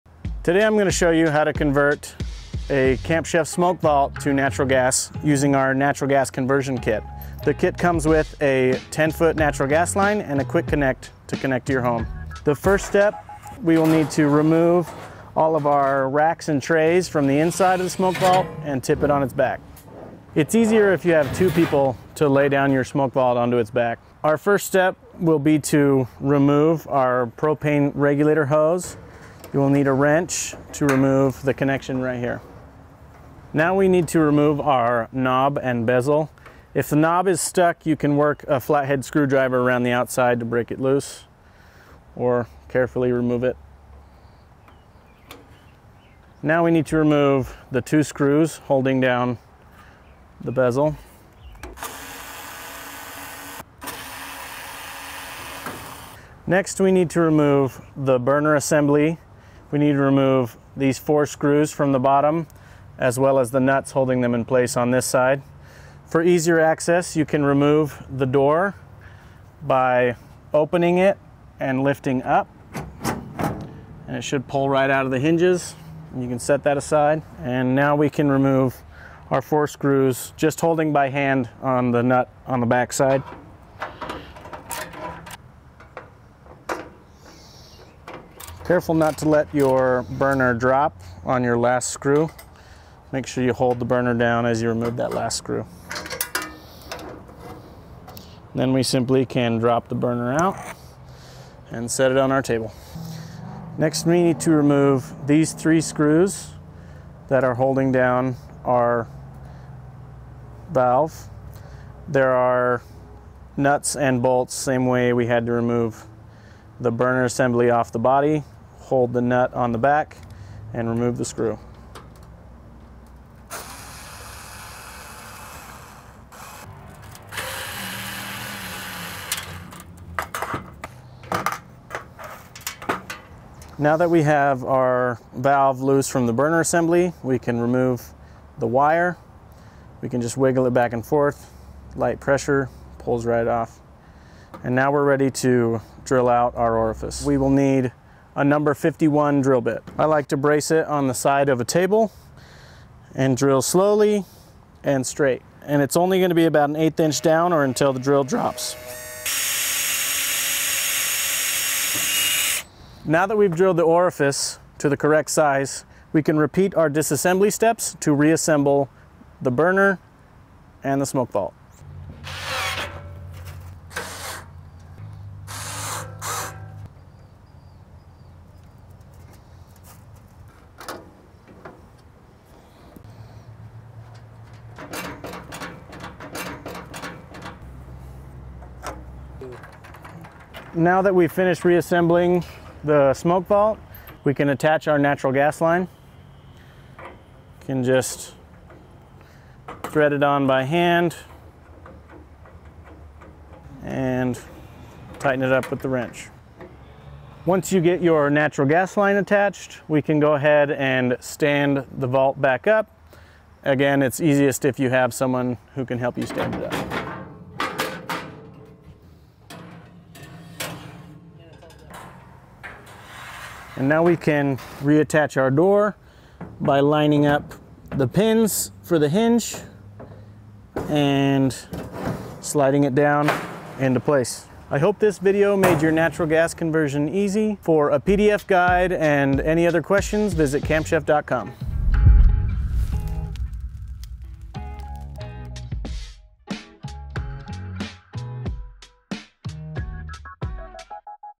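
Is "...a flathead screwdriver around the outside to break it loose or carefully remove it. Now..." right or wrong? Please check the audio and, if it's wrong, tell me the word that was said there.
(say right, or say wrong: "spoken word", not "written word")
right.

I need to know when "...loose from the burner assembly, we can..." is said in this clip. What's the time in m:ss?
2:15.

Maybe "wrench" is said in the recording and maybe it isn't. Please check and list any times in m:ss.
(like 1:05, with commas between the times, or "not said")
0:29, 3:25.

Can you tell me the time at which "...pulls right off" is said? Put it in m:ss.
2:22.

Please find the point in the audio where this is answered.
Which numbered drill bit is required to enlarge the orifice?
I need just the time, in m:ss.
2:28.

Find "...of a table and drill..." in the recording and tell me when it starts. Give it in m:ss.
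2:31.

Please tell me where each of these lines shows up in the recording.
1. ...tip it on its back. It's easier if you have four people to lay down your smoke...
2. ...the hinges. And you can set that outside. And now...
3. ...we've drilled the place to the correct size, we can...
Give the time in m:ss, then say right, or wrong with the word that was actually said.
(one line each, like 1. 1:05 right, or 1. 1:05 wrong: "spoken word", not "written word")
1. 0:18 wrong: "two", not "four"
2. 1:15 wrong: "aside", not "outside"
3. 2:43 wrong: "orifice", not "place".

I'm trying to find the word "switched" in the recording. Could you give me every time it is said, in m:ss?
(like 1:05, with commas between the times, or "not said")
not said.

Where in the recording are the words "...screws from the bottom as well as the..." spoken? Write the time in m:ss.
1:01.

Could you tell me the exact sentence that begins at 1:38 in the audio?
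Then we simply can drop the burner out and set it on our table.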